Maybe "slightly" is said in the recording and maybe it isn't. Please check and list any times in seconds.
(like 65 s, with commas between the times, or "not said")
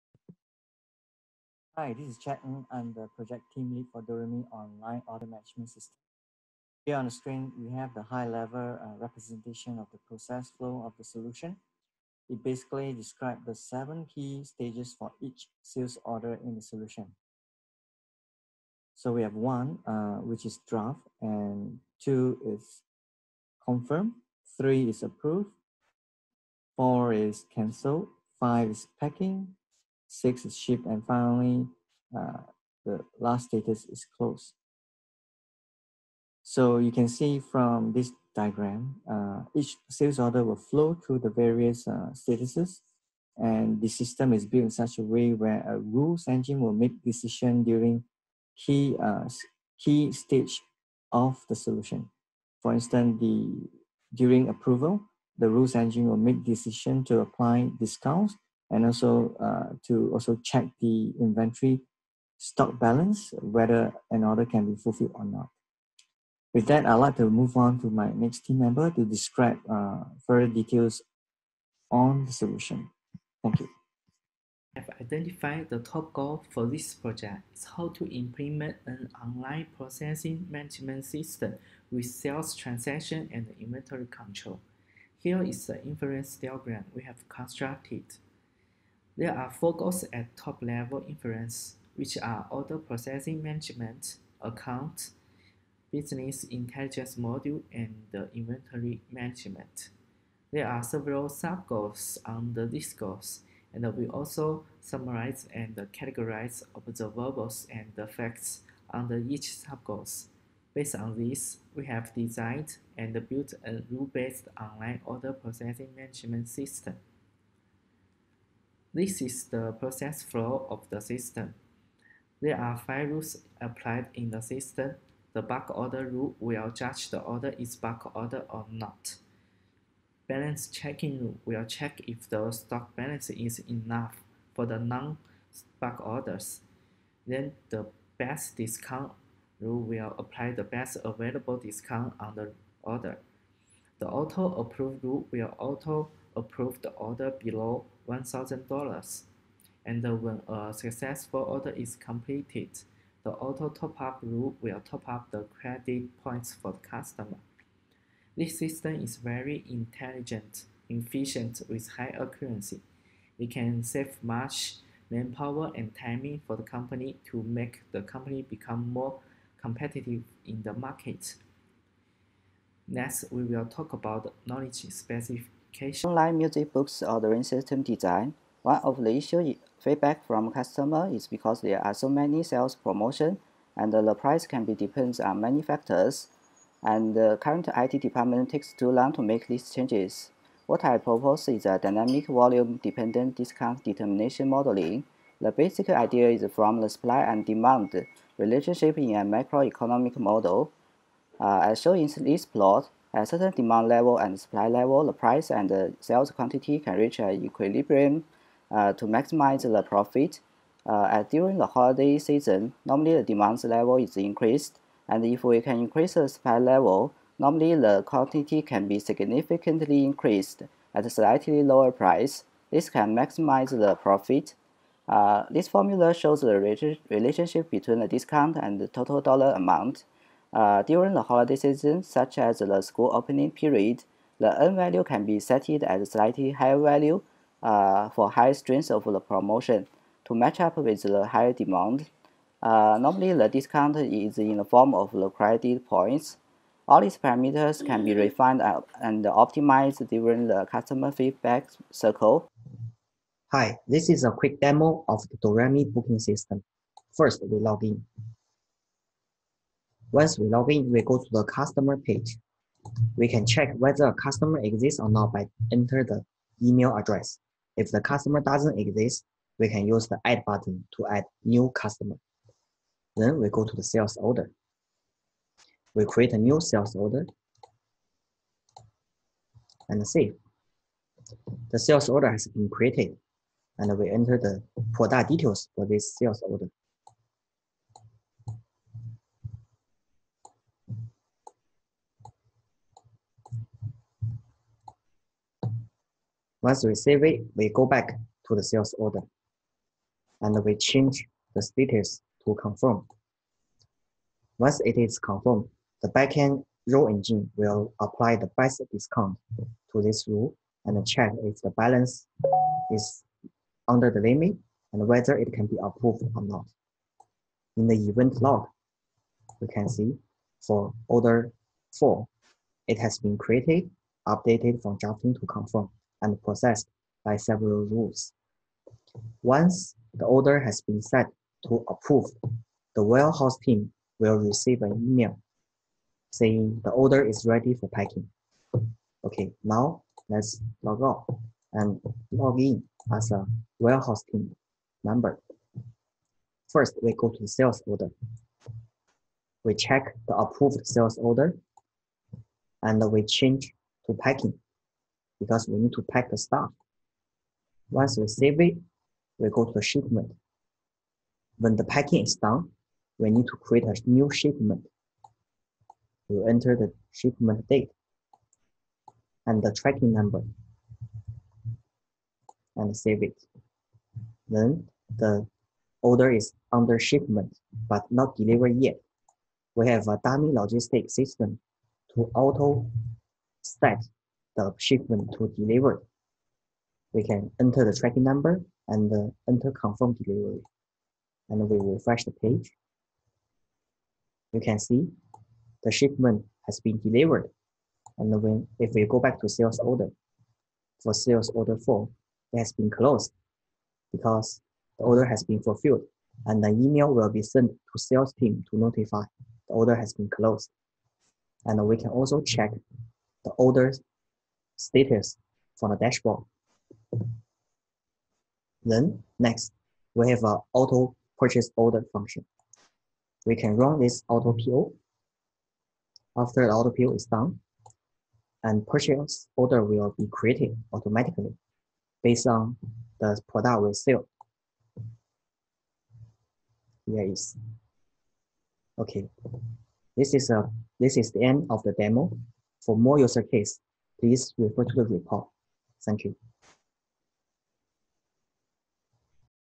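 221 s, 236 s.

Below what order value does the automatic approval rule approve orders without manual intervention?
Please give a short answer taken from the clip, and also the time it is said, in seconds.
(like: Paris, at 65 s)
$1,000, at 148 s.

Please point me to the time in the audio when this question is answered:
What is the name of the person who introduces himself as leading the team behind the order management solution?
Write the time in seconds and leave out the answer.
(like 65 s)
2 s.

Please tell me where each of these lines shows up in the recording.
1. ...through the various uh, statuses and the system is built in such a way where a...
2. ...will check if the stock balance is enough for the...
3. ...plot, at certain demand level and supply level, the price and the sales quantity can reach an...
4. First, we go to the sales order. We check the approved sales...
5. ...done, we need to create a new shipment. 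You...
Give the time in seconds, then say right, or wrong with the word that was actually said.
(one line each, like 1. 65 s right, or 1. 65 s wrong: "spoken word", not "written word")
1. 40 s right
2. 131 s right
3. 202 s right
4. 346 s right
5. 362 s right.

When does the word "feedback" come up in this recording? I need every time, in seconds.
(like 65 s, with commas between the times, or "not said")
179 s, 251 s.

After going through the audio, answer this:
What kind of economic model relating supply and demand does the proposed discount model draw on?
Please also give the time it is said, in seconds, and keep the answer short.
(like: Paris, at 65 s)
macroeconomic model, at 199 s.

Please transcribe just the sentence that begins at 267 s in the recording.
If the customer doesn't exist, we can use the add button to add new customer.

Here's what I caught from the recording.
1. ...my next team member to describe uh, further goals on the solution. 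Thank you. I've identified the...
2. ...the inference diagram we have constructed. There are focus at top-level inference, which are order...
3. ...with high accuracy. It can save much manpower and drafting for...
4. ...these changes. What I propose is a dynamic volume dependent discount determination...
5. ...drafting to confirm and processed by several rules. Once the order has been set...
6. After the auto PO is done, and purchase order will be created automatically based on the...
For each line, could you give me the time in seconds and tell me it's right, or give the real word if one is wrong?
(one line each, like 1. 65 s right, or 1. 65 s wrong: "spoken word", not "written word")
1. 67 s wrong: "details", not "goals"
2. 85 s right
3. 161 s wrong: "timing", not "drafting"
4. 189 s right
5. 324 s right
6. 426 s right.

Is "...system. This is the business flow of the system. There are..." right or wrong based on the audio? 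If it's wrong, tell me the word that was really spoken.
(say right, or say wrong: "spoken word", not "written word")
wrong: "process", not "business".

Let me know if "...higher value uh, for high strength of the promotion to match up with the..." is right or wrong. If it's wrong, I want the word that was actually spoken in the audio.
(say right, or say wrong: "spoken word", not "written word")
right.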